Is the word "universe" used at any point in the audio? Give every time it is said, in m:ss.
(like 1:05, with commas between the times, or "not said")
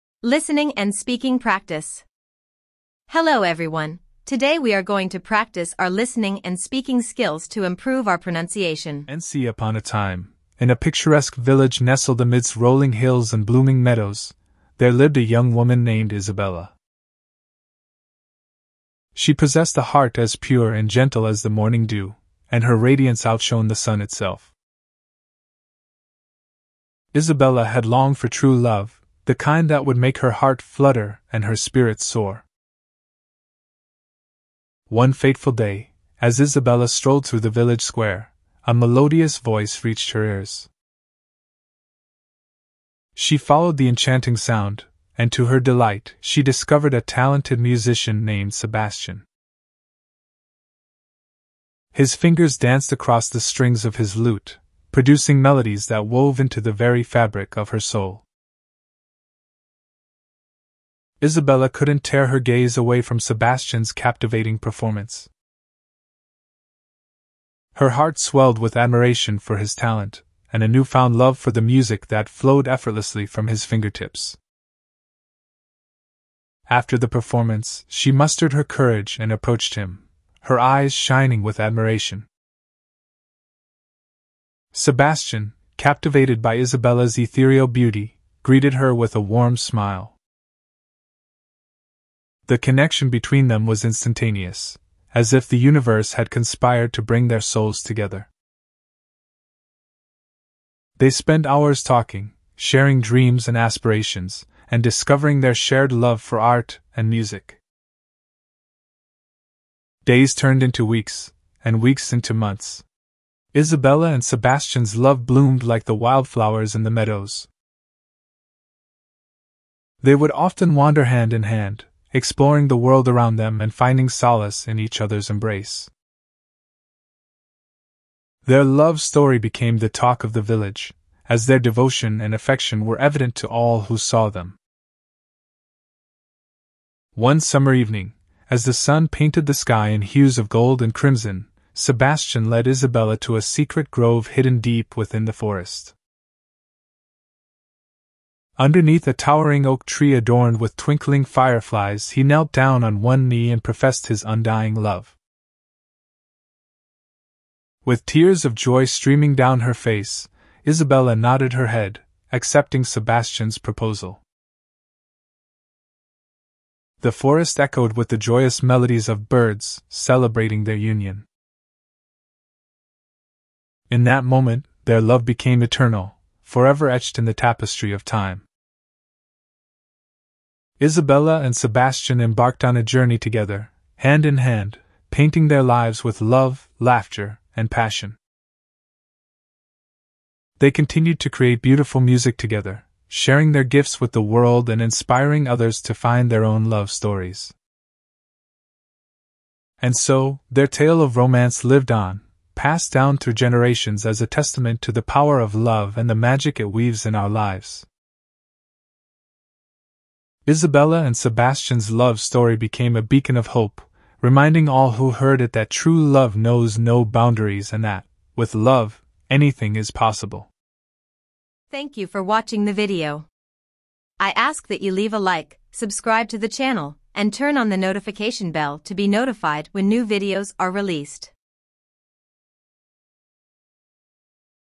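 1:35.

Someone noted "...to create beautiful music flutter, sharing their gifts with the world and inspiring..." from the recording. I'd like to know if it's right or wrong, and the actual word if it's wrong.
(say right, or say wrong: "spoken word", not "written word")
wrong: "together", not "flutter".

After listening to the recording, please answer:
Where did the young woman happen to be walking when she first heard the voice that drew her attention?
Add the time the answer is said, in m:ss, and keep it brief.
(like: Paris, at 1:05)
the village square, at 0:37.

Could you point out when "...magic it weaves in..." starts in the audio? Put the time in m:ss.
3:26.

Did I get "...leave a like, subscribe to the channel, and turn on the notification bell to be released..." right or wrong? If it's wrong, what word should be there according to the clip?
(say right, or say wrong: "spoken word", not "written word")
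wrong: "notified", not "released".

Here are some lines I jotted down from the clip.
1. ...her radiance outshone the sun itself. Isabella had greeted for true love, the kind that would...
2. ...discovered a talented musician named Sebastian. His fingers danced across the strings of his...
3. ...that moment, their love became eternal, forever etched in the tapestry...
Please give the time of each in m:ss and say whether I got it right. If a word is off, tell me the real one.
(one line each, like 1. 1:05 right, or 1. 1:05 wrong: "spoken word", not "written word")
1. 0:22 wrong: "longed", not "greeted"
2. 0:46 right
3. 2:54 right.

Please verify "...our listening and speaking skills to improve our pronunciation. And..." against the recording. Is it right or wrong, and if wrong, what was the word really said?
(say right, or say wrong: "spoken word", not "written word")
right.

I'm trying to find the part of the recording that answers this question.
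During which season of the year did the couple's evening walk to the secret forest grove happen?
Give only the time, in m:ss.
2:17.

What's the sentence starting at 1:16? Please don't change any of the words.
After the performance, she mustered her courage and approached him, her eyes shining with admiration.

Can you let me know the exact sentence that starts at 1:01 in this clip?
Isabella couldn't tear her gaze away from Sebastian's captivating performance.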